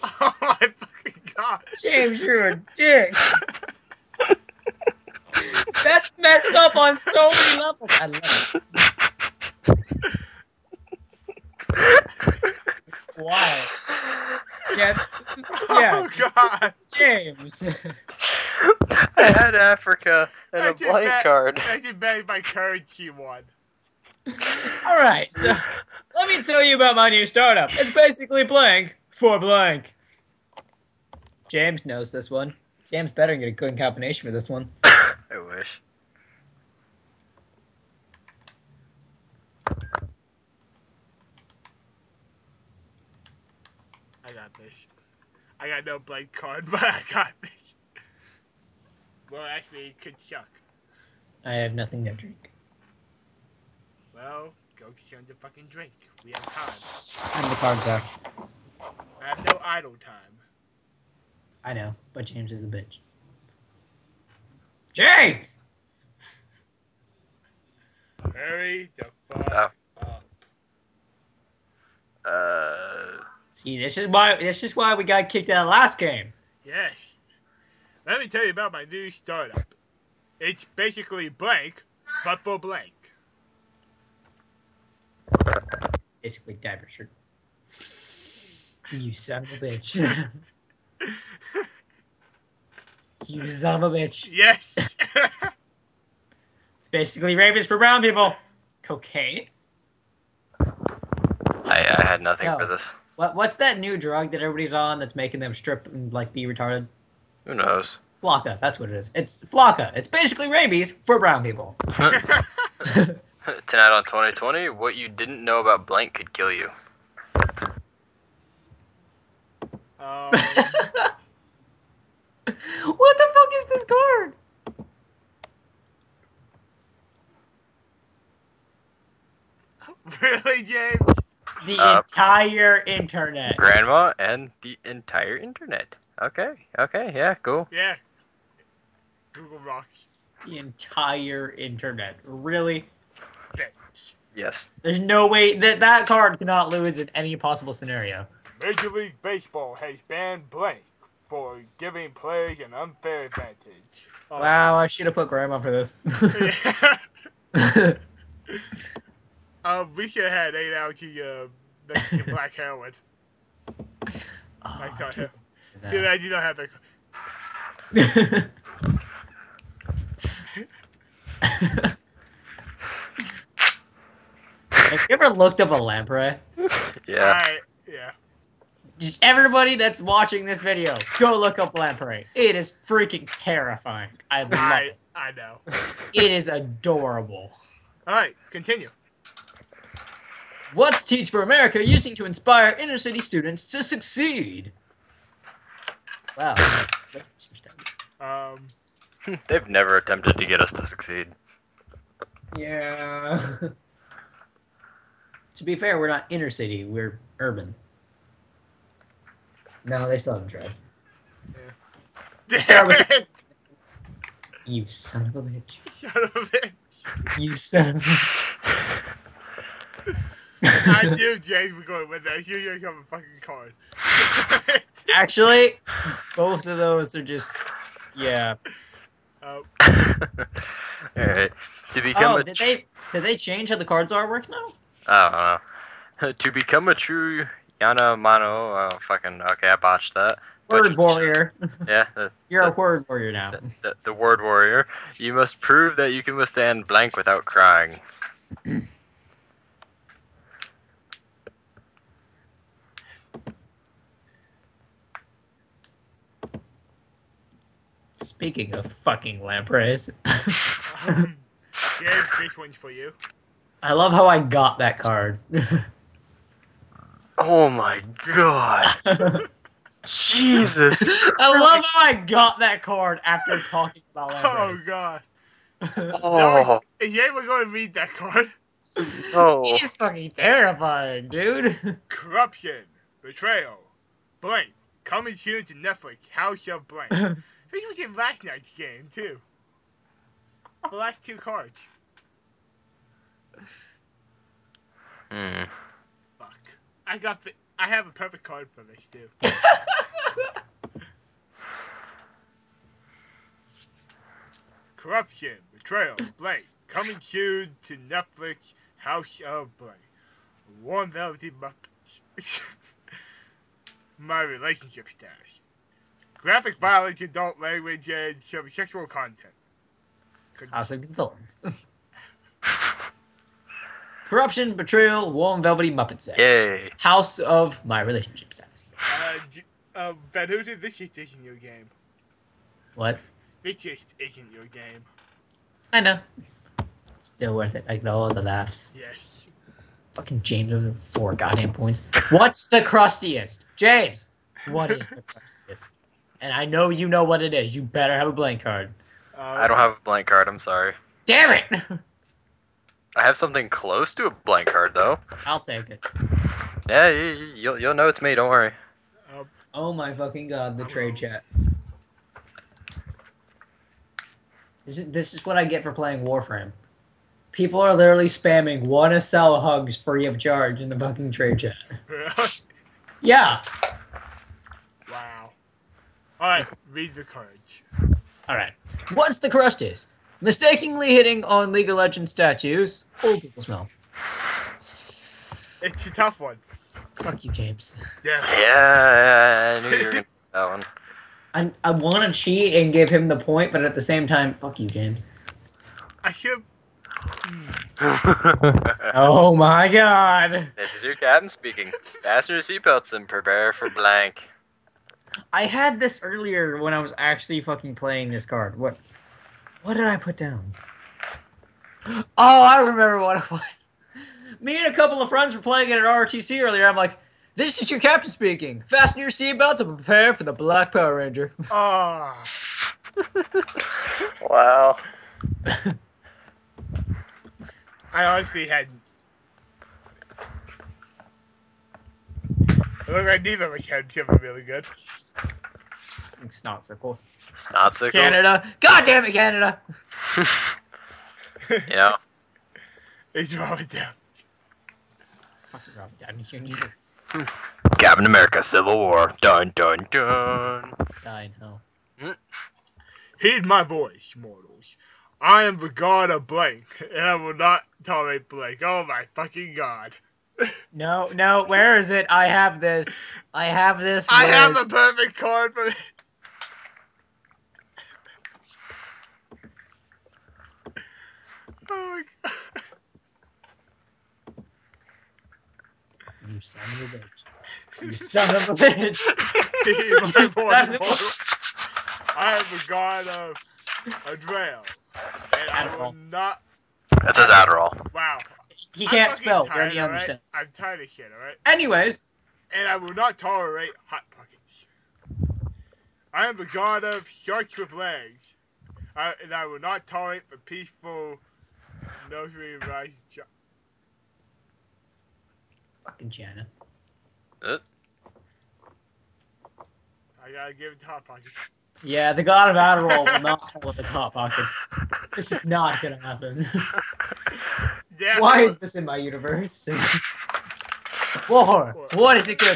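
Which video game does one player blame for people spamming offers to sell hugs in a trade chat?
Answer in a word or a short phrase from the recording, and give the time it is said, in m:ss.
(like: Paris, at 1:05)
Warframe, at 6:06.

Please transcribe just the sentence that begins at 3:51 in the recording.
To become oh, a did they did they change how the cards are work now?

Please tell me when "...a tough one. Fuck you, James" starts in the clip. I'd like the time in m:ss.
6:26.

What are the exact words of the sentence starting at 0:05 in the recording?
That's messed up on so many levels.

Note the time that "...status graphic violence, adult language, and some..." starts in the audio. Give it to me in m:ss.
5:15.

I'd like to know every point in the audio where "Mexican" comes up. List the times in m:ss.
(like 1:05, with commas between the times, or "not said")
2:41.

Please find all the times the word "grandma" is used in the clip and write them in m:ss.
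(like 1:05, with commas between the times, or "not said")
2:13, 2:35.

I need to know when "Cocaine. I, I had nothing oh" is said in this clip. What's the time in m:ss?
1:38.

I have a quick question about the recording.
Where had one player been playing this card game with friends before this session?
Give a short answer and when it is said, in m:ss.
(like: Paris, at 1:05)
ROTC, at 6:56.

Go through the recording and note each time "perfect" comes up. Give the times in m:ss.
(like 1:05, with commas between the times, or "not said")
4:58, 7:44.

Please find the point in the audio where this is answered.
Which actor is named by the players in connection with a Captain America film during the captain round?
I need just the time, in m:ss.
7:25.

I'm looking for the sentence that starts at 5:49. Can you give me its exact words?
Uh, I don't have a blank card.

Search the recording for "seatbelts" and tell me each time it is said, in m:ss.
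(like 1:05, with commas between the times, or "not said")
6:42, 6:59.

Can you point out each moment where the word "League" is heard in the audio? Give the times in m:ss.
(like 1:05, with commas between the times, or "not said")
2:28, 6:21.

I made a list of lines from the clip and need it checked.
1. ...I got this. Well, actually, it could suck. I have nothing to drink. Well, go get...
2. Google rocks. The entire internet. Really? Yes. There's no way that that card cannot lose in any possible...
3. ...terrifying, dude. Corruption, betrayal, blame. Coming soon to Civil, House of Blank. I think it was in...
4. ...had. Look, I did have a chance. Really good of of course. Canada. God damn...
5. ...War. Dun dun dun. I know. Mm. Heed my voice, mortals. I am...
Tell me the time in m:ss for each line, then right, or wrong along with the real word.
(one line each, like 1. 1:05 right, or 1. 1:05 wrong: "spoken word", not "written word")
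1. 0:46 right
2. 2:19 right
3. 4:40 wrong: "Netflix", not "Civil"
4. 7:08 right
5. 7:28 right.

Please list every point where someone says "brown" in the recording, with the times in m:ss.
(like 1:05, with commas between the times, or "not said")
1:37, 1:51.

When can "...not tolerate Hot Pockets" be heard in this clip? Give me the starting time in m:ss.
8:13.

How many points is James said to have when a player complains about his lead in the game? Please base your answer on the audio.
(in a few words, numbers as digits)
4.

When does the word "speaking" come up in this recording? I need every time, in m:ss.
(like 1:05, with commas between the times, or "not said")
4:18, 6:41, 6:58.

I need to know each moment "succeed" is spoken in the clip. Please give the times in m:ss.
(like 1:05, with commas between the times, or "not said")
3:13, 3:20.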